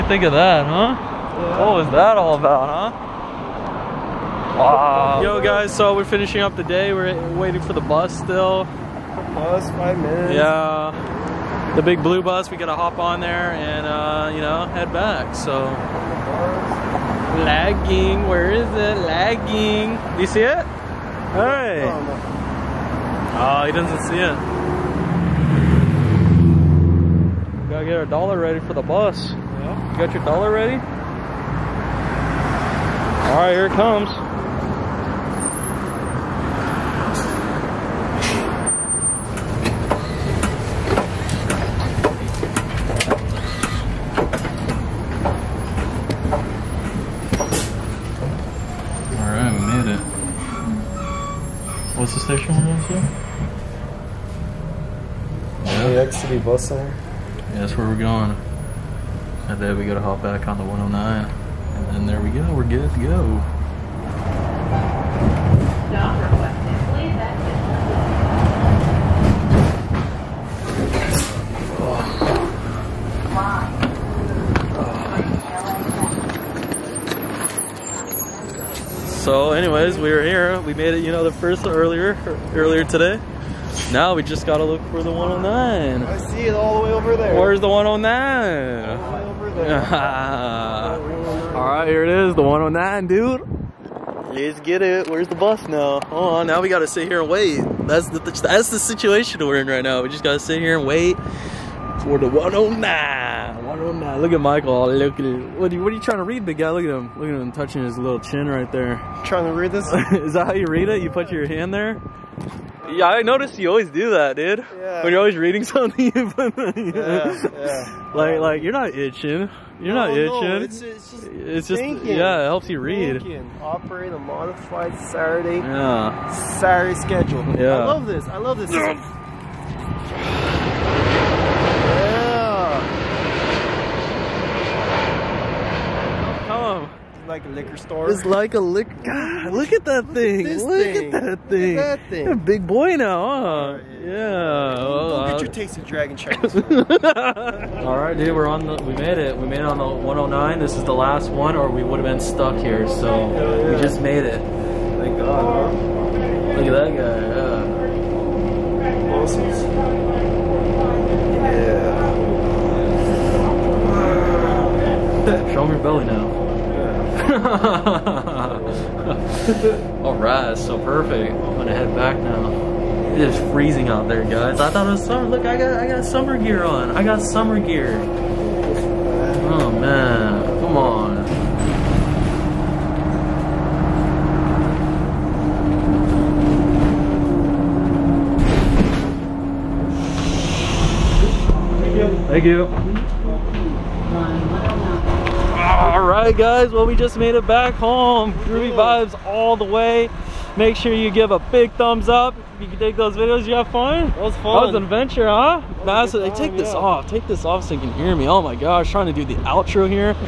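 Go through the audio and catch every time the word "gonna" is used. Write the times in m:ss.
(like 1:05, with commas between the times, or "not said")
2:51.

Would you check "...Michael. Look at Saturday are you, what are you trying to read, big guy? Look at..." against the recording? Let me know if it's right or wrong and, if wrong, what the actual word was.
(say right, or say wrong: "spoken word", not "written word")
wrong: "What", not "Saturday".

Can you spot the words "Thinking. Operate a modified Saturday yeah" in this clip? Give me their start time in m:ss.
2:03.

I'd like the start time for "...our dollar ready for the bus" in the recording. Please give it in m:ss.
0:27.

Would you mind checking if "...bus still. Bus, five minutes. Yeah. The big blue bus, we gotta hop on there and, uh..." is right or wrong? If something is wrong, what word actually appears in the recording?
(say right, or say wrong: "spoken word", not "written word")
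right.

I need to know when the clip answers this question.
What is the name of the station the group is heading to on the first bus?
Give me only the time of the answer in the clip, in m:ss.
0:56.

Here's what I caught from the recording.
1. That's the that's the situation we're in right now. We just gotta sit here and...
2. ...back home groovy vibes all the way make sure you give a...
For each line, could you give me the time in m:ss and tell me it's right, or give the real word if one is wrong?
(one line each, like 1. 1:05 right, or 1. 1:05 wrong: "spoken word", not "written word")
1. 1:37 right
2. 3:17 right.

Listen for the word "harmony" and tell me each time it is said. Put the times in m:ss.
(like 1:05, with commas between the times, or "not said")
not said.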